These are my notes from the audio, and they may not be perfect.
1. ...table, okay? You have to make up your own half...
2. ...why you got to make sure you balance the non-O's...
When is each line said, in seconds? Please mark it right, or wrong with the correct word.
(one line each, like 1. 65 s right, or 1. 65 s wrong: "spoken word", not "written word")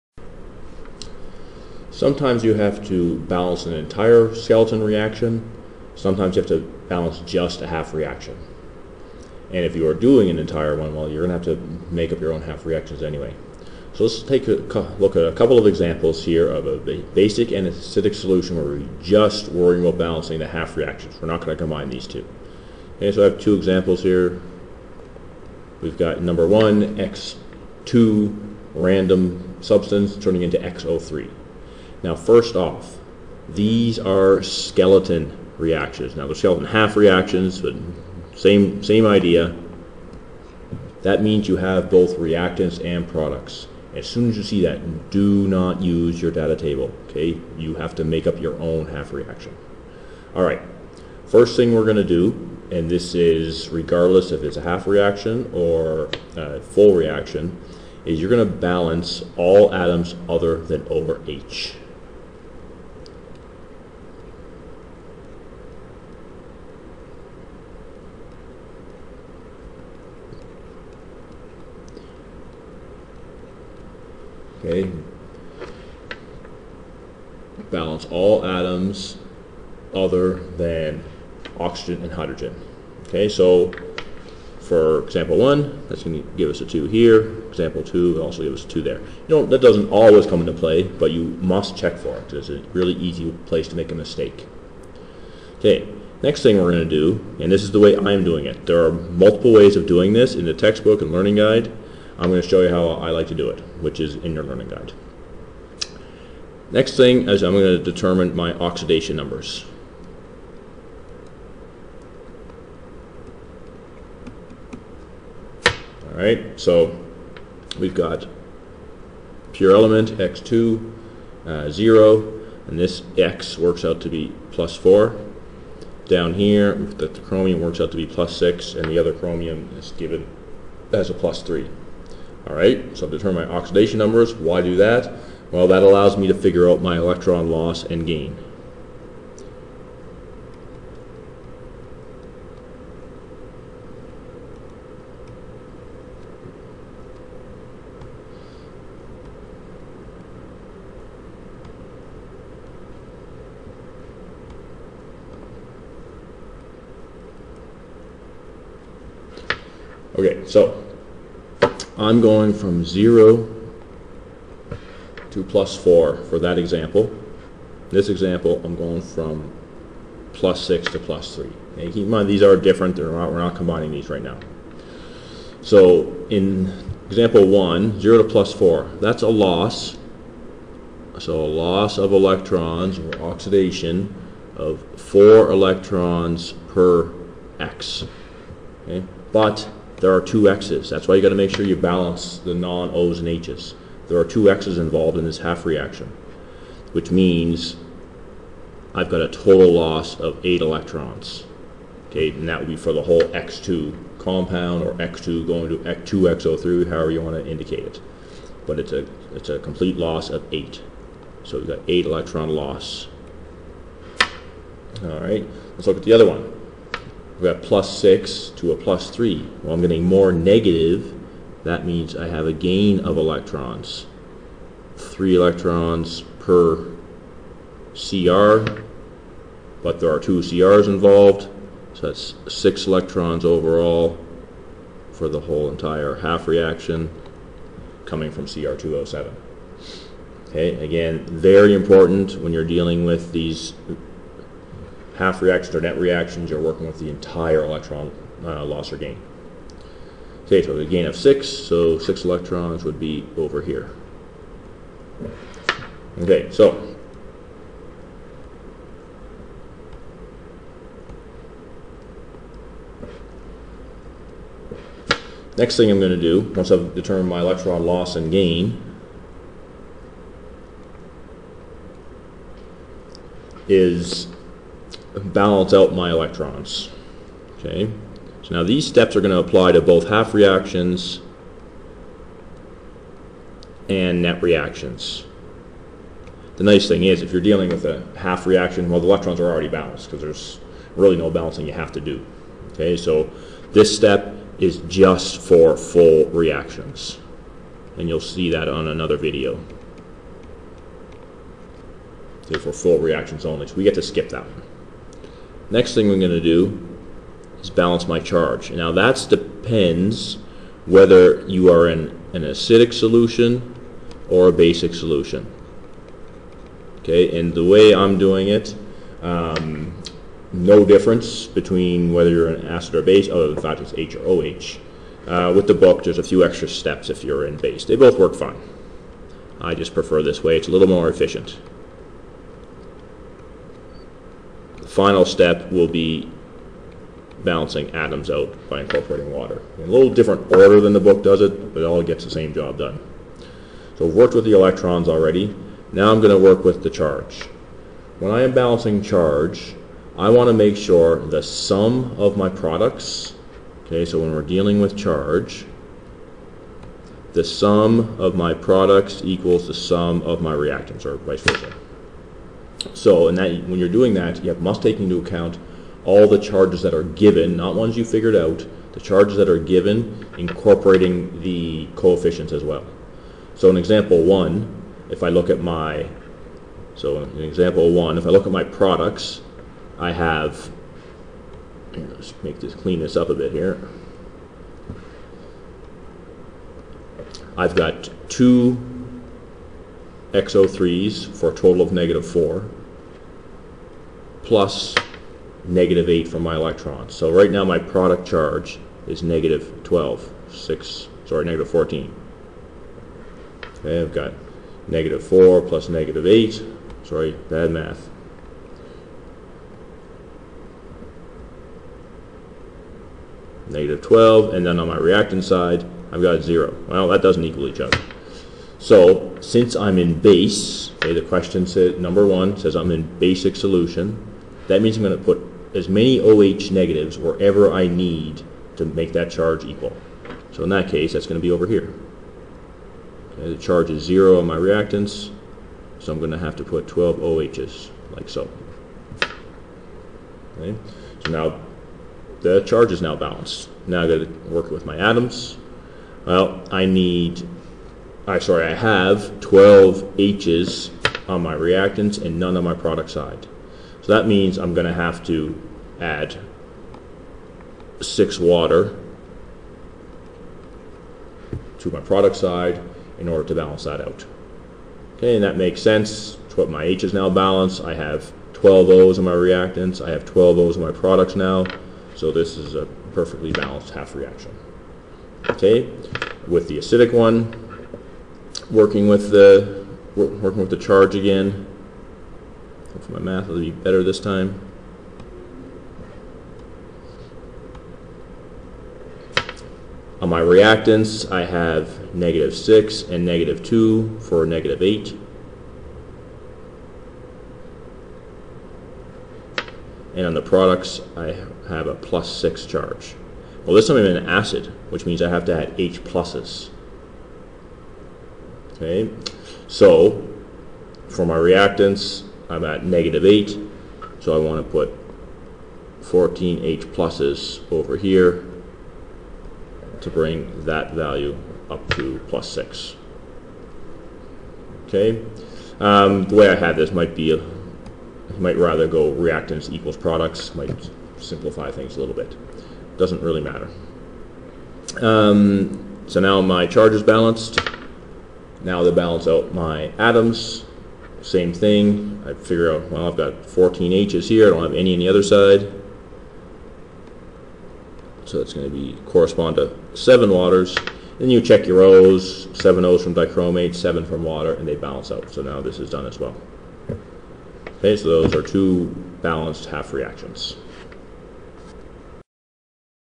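1. 46 s right
2. 191 s right.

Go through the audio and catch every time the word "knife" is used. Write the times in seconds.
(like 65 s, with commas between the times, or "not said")
not said.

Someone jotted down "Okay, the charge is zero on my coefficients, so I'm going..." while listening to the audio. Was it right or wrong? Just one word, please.
wrong.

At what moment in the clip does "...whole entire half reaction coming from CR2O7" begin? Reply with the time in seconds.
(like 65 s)
235 s.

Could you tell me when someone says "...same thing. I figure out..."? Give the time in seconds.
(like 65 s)
541 s.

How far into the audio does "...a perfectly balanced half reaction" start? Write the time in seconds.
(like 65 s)
472 s.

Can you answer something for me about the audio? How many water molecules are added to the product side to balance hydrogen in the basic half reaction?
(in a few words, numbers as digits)
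6.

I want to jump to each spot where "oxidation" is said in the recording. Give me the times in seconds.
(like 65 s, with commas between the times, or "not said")
108 s, 133 s, 183 s.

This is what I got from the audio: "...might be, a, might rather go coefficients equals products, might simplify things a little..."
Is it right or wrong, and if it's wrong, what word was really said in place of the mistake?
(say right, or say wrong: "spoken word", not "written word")
wrong: "reactants", not "coefficients".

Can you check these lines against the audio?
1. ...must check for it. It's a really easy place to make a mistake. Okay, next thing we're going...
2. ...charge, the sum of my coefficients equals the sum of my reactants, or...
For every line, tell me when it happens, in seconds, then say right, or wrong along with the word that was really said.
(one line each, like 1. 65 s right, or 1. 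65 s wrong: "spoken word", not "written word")
1. 91 s right
2. 354 s wrong: "products", not "coefficients".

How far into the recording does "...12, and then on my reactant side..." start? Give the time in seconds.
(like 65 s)
414 s.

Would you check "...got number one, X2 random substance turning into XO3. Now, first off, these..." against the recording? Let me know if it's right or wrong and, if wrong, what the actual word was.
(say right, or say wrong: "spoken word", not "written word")
right.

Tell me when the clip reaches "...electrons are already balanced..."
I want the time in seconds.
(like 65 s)
289 s.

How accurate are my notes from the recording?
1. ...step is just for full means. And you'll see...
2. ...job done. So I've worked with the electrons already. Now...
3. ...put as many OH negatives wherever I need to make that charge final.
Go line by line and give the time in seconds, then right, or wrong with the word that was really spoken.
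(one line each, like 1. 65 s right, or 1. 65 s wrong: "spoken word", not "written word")
1. 293 s wrong: "reactions", not "means"
2. 342 s right
3. 425 s wrong: "equal", not "final".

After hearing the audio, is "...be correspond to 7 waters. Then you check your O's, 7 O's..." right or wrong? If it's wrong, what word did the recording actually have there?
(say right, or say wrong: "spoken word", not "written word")
right.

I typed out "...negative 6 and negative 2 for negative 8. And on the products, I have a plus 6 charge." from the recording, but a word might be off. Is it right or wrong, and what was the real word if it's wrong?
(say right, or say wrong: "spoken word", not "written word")
right.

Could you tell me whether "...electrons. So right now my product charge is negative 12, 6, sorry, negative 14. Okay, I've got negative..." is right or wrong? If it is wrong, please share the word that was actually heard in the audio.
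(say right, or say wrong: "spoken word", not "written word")
right.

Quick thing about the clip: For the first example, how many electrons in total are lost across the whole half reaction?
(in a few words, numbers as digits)
8.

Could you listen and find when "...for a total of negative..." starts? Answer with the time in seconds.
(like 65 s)
391 s.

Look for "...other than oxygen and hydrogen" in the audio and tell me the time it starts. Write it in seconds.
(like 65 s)
79 s.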